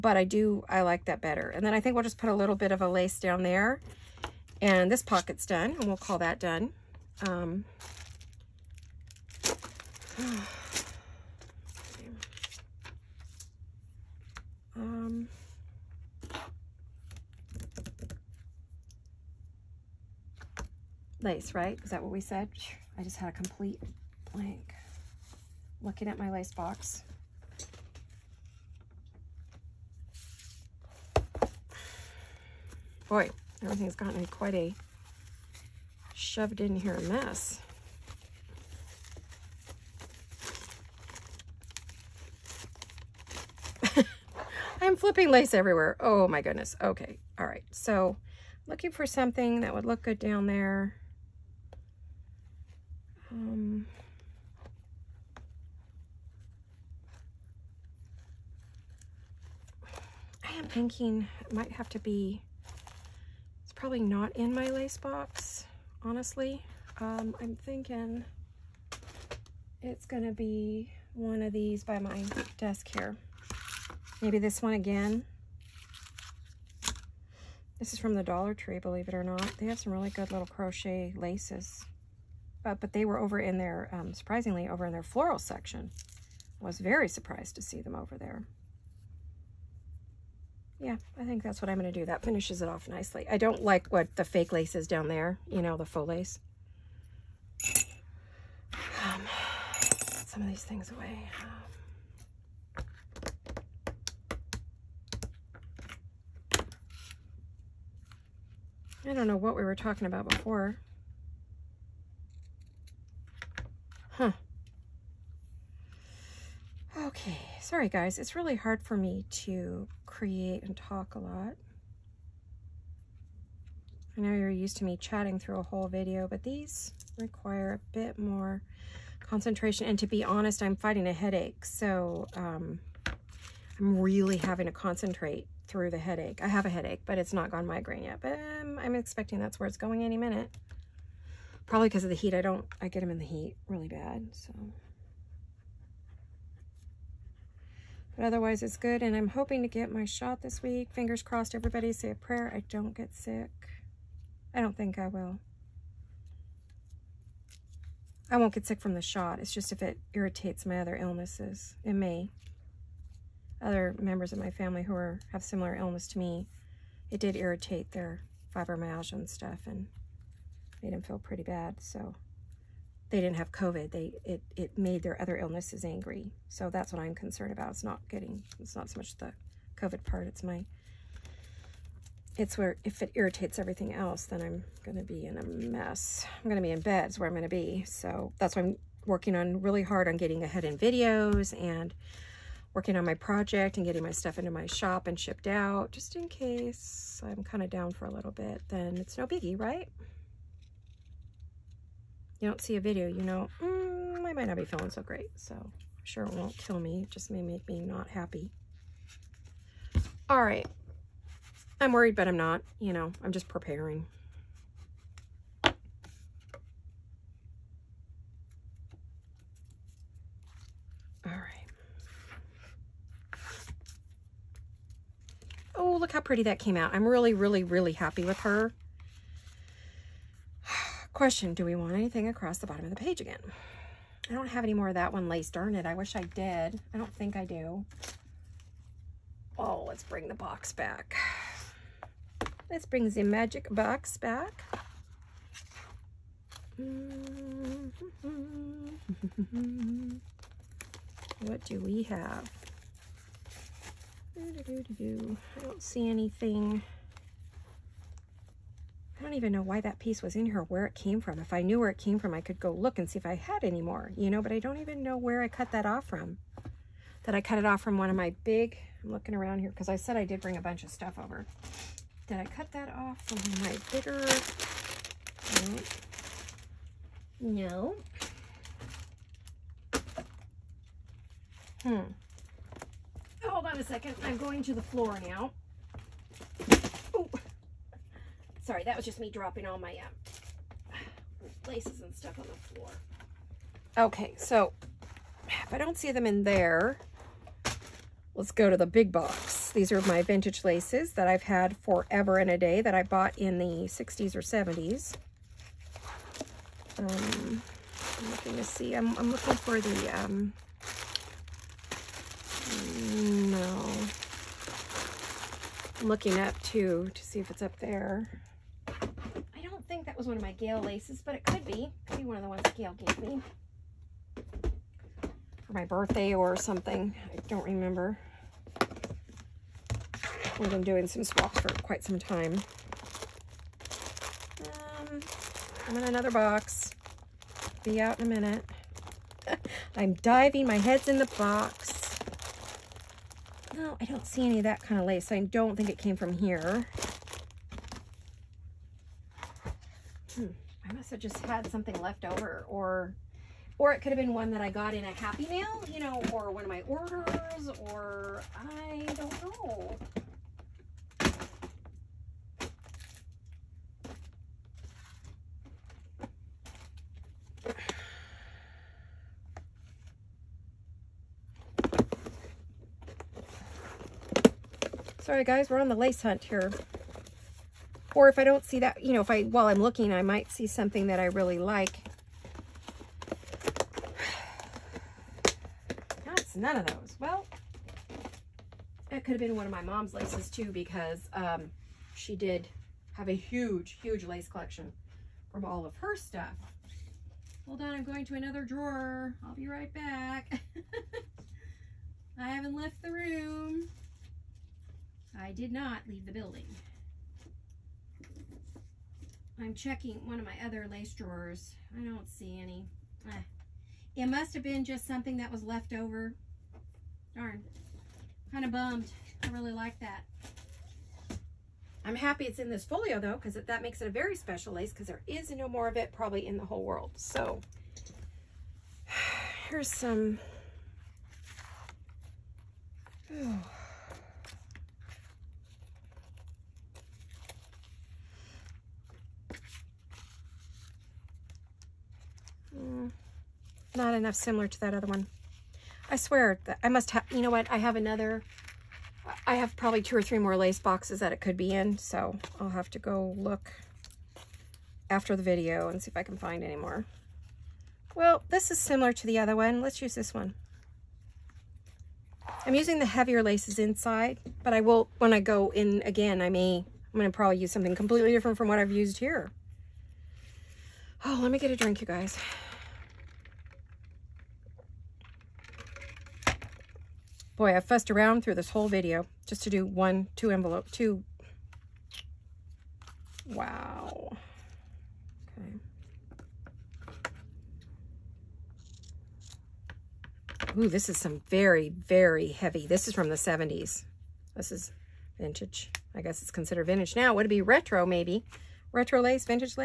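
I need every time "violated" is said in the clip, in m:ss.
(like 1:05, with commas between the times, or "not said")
not said.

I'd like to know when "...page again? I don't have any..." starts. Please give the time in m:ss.
3:52.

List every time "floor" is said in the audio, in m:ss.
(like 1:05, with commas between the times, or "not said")
4:44, 4:52.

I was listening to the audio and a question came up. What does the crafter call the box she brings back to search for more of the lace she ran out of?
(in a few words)
magic box.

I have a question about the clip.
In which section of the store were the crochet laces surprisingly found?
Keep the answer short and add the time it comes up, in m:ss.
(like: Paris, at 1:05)
floral section, at 1:25.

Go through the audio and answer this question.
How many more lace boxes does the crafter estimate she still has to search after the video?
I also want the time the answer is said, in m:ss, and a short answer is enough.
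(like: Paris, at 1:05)
two or three, at 7:30.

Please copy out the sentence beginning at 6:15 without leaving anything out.
Sorry guys, we're on the lace hunt here.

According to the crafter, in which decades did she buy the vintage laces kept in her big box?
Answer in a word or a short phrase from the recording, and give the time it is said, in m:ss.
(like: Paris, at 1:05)
60s or 70s, at 5:03.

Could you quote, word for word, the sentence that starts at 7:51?
Oh, let me get a drink, you guys.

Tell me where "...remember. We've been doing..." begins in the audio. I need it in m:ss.
5:27.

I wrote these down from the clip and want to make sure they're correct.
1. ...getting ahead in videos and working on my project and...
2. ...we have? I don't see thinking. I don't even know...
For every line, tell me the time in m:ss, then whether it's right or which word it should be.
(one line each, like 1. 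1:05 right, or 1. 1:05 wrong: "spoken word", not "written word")
1. 3:10 right
2. 4:11 wrong: "anything", not "thinking".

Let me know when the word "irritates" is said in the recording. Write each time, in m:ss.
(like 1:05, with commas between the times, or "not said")
2:40, 2:47, 3:03.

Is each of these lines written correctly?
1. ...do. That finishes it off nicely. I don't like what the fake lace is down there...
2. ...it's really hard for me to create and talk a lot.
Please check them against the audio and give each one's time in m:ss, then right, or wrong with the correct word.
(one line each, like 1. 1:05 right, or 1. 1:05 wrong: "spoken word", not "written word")
1. 1:31 right
2. 1:58 right.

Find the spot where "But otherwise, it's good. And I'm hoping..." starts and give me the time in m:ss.
2:28.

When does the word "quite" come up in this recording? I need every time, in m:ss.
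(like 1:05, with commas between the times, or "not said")
0:34, 5:31.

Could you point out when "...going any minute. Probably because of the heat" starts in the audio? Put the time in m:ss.
2:19.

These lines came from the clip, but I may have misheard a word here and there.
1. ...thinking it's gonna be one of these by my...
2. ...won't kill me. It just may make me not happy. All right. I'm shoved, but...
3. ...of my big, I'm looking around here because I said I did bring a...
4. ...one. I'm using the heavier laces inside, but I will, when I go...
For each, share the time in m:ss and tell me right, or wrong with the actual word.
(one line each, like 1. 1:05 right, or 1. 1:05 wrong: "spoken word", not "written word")
1. 1:07 right
2. 3:26 wrong: "worried", not "shoved"
3. 4:28 right
4. 7:40 right.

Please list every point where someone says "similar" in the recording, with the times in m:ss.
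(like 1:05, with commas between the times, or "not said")
2:45, 7:24, 7:38.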